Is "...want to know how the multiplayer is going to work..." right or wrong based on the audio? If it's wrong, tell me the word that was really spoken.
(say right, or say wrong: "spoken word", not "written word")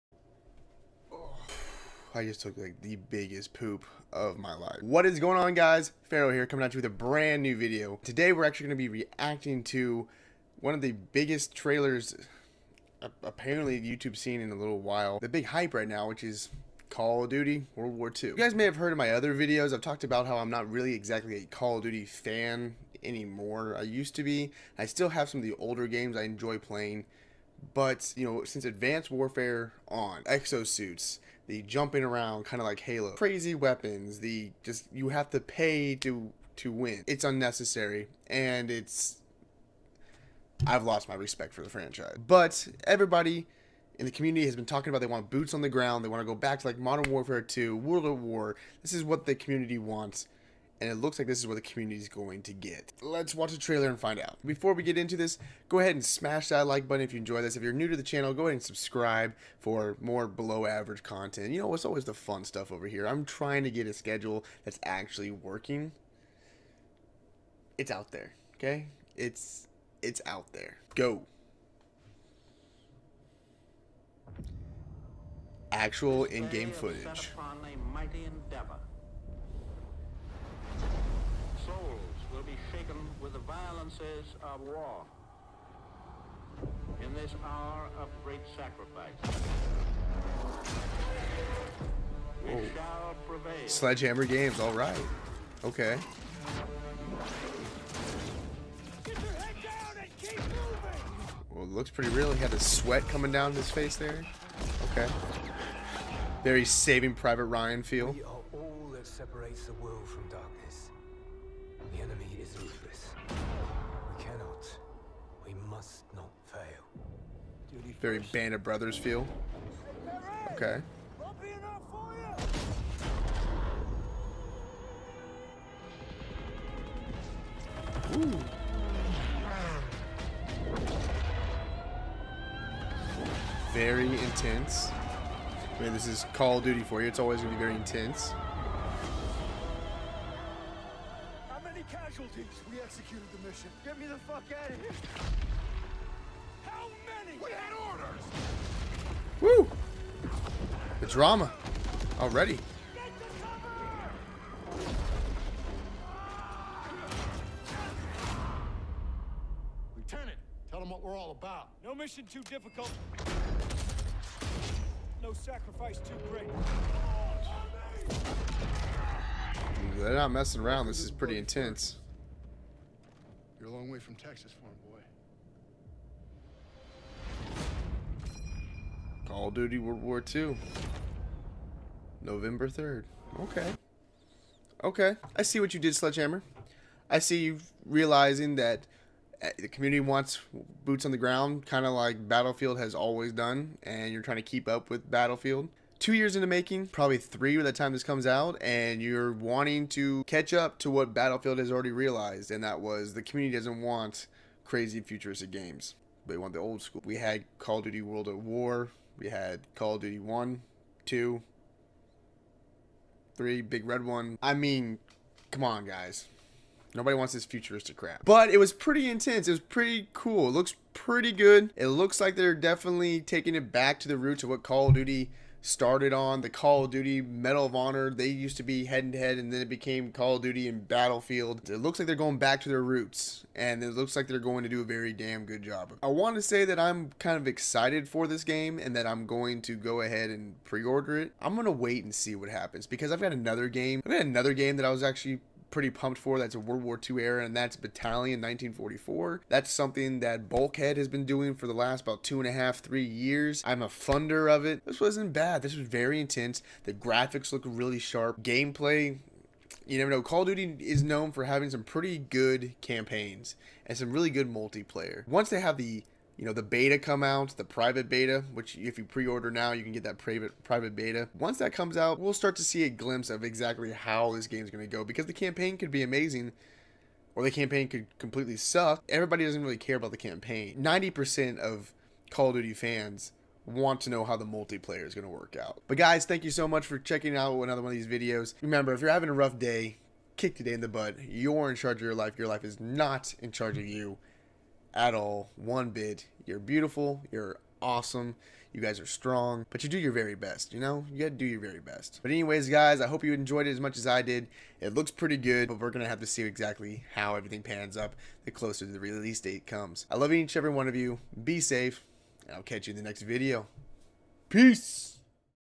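right.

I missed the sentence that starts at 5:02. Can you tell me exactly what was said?
But, anyways, guys, I hope you enjoyed it as much as I did.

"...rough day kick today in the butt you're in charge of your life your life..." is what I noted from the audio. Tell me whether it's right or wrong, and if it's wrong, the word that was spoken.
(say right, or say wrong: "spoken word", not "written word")
right.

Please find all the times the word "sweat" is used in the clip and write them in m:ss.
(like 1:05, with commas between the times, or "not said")
1:42.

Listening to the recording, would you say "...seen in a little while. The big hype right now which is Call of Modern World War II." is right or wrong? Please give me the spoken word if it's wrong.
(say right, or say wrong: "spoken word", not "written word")
wrong: "Duty", not "Modern".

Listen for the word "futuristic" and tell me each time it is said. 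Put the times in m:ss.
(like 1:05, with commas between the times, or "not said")
3:24, 3:37.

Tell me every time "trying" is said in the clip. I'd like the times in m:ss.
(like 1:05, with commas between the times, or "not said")
1:03, 3:14.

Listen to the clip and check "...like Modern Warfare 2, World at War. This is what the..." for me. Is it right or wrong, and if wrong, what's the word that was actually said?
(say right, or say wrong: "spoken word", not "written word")
right.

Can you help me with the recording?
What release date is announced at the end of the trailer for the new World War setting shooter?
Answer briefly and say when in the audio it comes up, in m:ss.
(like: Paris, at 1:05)
November 3rd, at 3:02.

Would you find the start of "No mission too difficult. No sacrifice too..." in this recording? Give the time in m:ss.
2:41.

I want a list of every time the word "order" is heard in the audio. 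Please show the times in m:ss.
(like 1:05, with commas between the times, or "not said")
2:27, 4:00, 4:29.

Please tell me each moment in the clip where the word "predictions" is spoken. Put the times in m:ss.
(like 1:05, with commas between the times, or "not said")
not said.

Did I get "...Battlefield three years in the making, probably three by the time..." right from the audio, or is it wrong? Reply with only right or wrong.
wrong.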